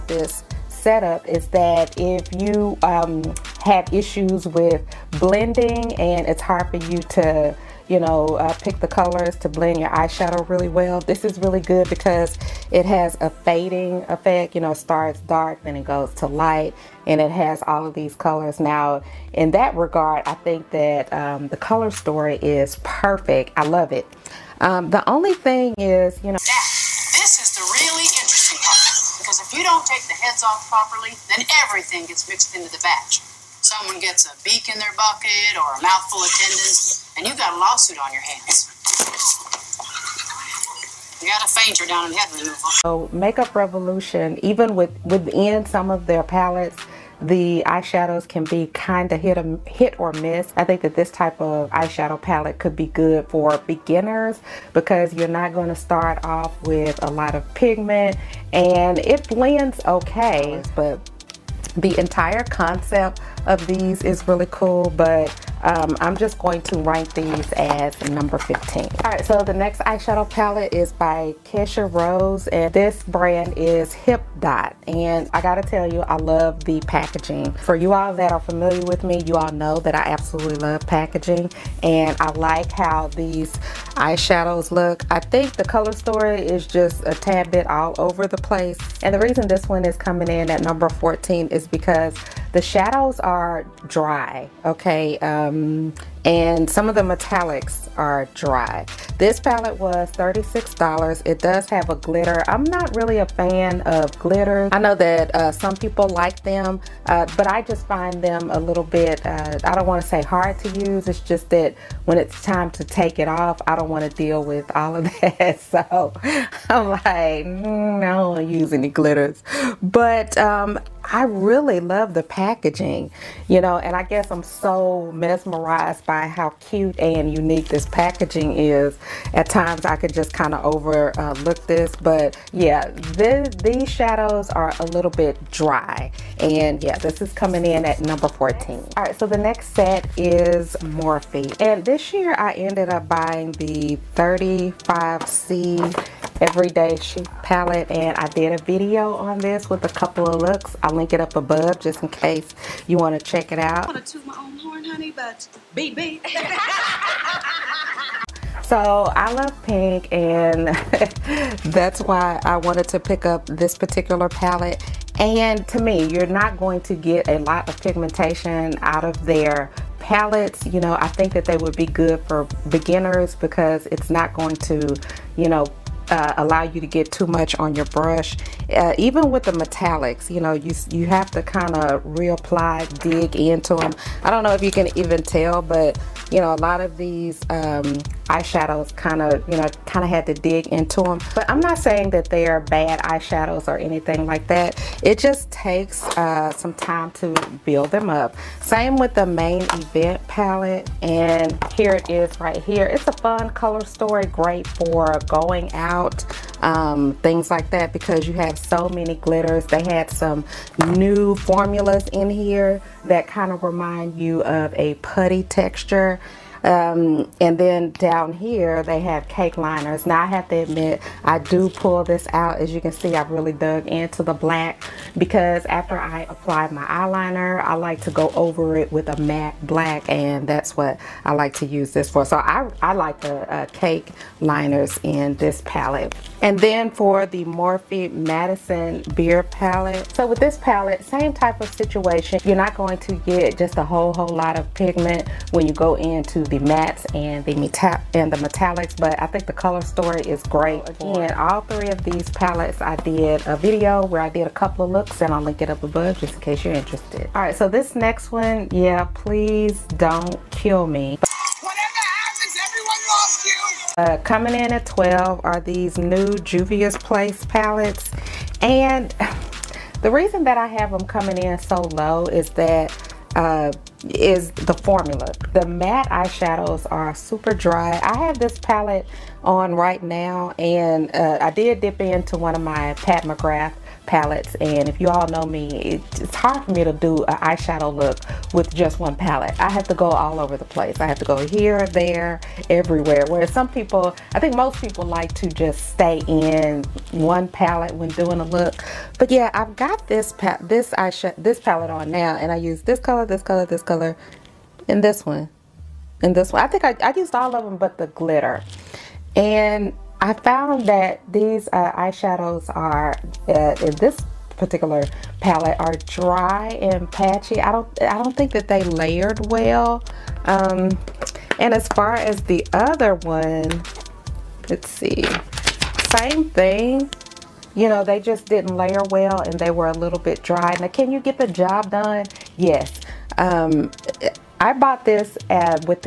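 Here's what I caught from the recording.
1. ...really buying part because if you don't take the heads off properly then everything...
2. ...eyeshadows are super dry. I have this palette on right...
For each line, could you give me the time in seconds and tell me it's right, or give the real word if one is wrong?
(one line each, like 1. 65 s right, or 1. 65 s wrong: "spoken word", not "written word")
1. 27 s wrong: "interesting", not "buying"
2. 276 s right.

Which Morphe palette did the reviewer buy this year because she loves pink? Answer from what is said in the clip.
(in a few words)
35C everyday chic.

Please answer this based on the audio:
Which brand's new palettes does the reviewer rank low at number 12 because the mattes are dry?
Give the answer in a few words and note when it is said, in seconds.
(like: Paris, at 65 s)
Juvia's Place, at 266 s.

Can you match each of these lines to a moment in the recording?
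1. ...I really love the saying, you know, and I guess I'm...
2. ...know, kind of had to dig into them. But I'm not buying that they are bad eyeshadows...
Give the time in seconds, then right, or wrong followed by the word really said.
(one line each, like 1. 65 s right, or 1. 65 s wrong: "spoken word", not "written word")
1. 121 s wrong: "packaging", not "saying"
2. 189 s wrong: "saying", not "buying".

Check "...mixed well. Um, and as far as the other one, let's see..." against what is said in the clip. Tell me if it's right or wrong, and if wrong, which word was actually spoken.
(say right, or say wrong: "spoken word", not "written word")
wrong: "layered", not "mixed".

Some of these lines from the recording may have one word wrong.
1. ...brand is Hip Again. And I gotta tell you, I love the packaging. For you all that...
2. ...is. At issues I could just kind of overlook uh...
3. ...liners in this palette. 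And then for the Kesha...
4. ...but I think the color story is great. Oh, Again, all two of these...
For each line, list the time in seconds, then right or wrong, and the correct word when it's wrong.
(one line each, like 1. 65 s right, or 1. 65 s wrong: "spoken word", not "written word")
1. 73 s wrong: "Dot", not "Again"
2. 128 s wrong: "times", not "issues"
3. 234 s wrong: "Morphe", not "Kesha"
4. 248 s wrong: "three", not "two".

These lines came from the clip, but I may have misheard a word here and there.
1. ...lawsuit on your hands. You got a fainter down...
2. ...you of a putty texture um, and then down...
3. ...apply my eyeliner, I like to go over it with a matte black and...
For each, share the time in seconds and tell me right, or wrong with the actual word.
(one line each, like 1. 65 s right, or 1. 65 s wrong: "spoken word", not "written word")
1. 37 s right
2. 214 s right
3. 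226 s right.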